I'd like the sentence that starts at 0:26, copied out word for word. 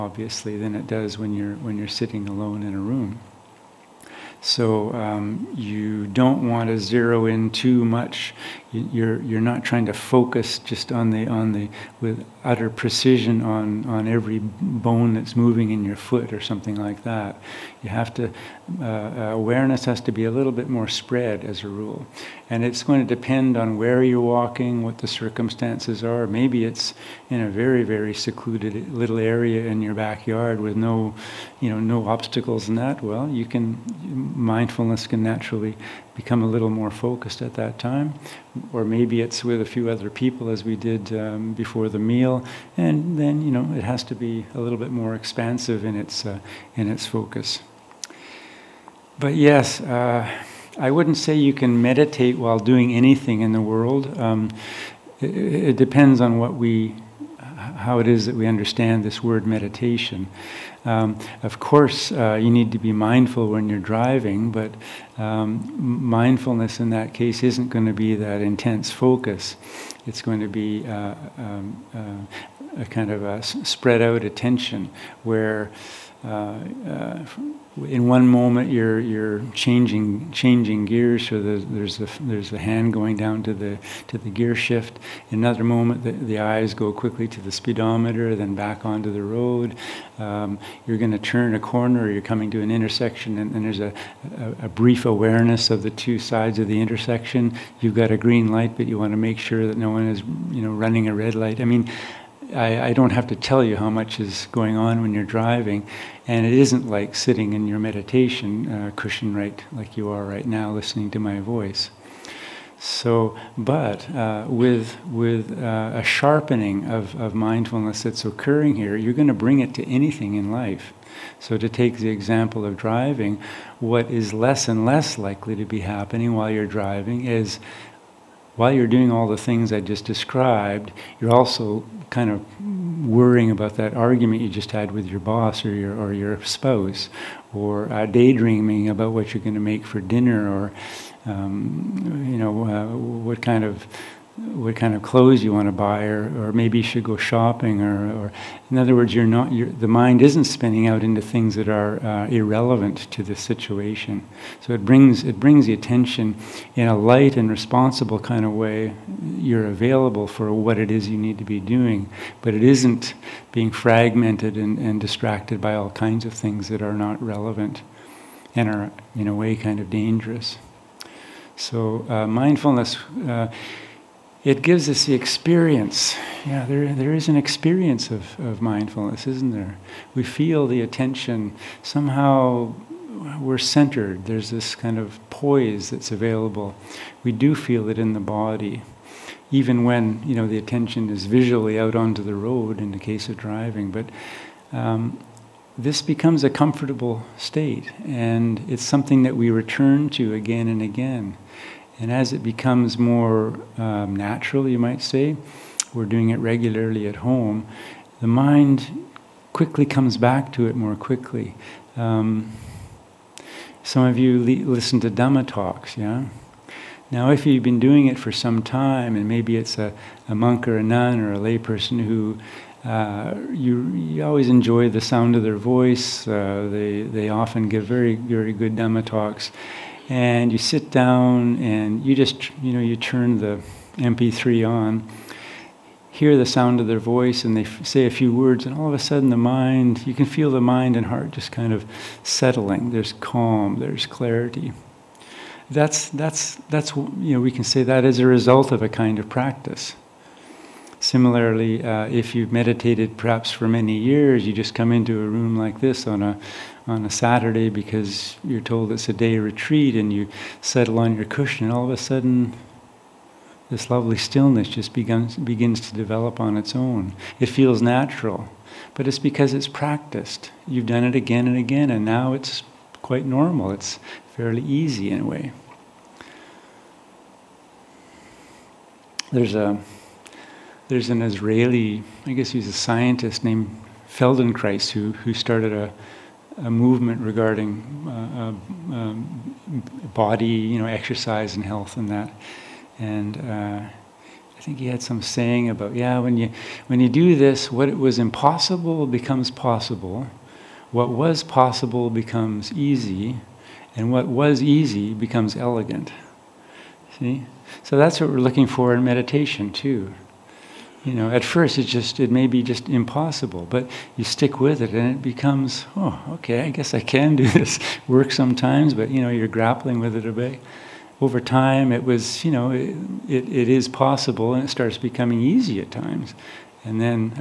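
Maybe it's in a very very secluded little area in your backyard with no, you know, no obstacles and that.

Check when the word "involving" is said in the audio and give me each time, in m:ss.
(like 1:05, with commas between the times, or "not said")
not said.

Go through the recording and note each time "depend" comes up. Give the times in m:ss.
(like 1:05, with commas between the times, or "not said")
0:23, 0:55.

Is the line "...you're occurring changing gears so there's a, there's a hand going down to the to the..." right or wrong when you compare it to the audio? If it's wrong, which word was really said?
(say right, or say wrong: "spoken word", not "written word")
wrong: "changing", not "occurring".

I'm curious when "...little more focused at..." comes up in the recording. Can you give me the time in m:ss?
0:36.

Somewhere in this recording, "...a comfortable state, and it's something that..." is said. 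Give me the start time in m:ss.
3:16.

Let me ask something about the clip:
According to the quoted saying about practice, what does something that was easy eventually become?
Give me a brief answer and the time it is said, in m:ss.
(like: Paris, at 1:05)
elegant, at 5:05.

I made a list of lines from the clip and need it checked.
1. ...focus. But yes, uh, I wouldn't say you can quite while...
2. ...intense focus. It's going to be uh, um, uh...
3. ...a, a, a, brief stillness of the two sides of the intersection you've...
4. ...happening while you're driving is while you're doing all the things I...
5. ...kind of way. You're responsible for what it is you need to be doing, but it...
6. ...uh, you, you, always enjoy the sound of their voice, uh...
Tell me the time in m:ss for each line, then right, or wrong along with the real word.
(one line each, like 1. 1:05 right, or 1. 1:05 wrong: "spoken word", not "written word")
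1. 0:47 wrong: "meditate", not "quite"
2. 1:08 right
3. 1:33 wrong: "awareness", not "stillness"
4. 2:05 right
5. 2:38 wrong: "available", not "responsible"
6. 3:42 right.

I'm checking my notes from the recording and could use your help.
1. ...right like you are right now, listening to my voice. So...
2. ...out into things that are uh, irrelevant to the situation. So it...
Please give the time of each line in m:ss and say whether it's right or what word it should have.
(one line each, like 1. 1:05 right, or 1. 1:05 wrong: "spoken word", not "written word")
1. 1:49 right
2. 2:30 right.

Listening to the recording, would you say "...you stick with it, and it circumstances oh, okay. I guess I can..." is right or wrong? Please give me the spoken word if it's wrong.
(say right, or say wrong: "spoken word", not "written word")
wrong: "becomes", not "circumstances".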